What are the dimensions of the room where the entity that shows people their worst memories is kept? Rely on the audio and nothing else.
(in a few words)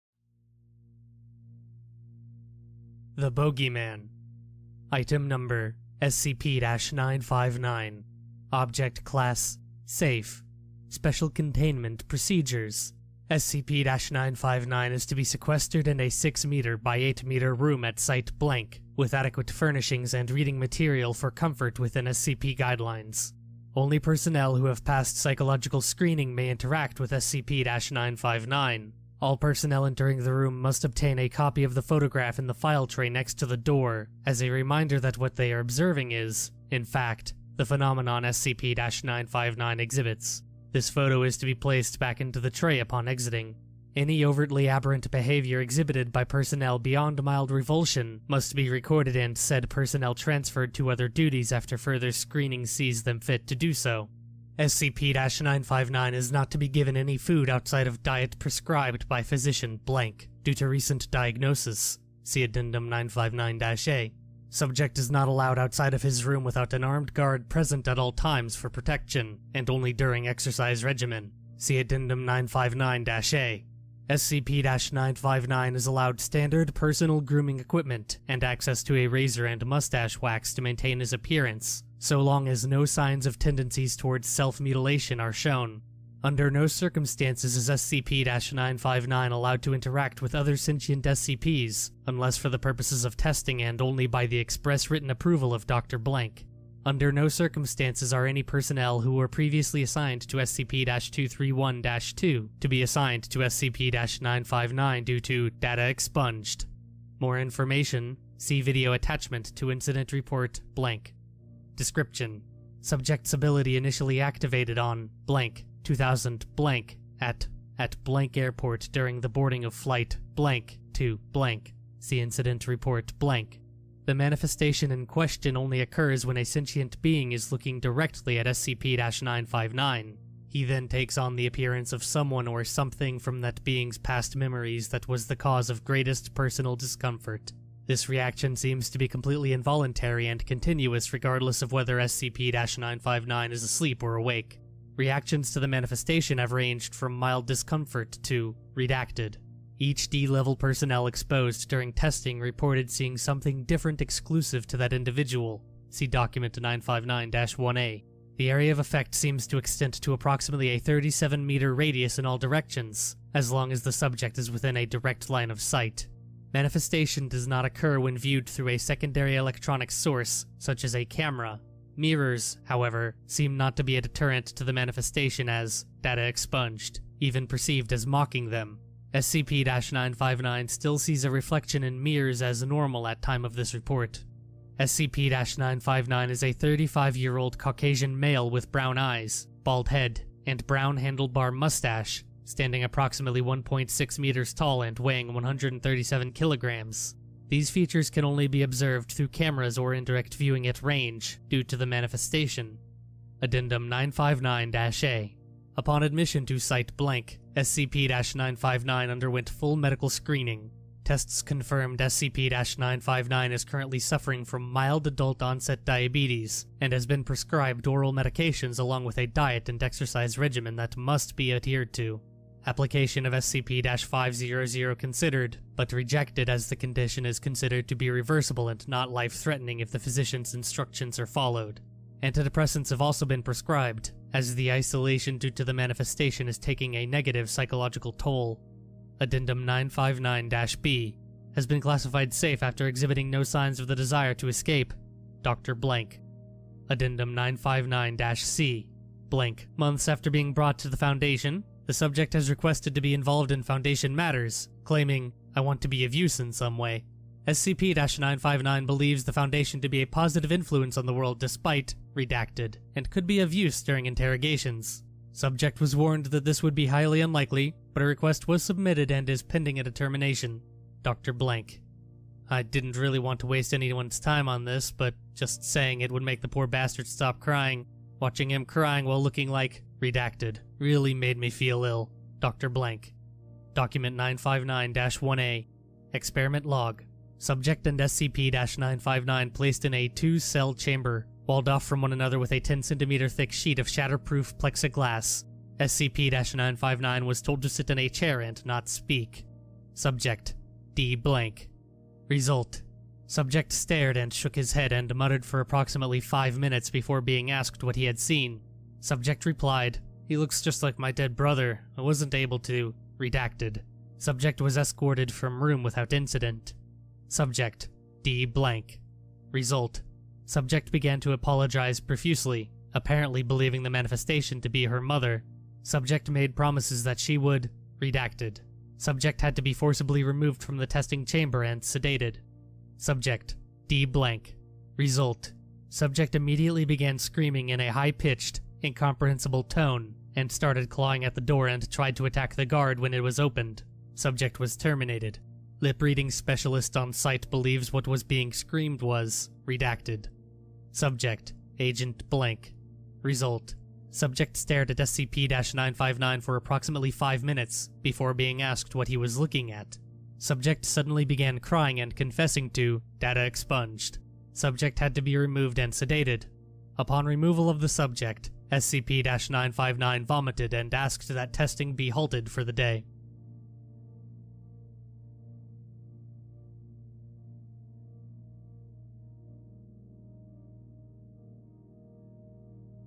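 6 meters by 8 meters.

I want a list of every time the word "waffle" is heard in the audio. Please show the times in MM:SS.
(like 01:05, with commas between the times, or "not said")
not said.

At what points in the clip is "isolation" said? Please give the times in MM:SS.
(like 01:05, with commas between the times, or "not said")
03:54.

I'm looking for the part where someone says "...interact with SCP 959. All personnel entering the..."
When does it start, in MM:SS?
00:26.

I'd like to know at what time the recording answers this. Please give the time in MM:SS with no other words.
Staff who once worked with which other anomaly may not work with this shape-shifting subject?
01:40.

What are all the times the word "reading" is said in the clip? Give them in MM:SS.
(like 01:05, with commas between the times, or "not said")
00:20, 05:45.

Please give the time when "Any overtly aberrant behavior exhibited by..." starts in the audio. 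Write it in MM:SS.
00:43.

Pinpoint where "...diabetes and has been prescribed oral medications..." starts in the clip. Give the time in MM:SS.
03:35.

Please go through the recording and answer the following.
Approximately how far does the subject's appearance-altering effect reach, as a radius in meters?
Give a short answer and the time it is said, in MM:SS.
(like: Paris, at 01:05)
37 meters, at 02:40.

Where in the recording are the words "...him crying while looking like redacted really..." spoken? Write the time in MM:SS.
04:38.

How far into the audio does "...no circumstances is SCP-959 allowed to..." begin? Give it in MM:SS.
01:26.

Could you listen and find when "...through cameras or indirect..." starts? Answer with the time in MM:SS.
03:19.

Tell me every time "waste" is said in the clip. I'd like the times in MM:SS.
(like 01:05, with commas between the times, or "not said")
04:33.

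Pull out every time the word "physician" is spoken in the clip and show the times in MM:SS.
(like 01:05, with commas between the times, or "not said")
00:59, 03:49.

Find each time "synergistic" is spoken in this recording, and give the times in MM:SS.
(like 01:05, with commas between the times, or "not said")
not said.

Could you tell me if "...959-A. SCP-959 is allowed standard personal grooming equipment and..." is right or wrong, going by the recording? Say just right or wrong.
right.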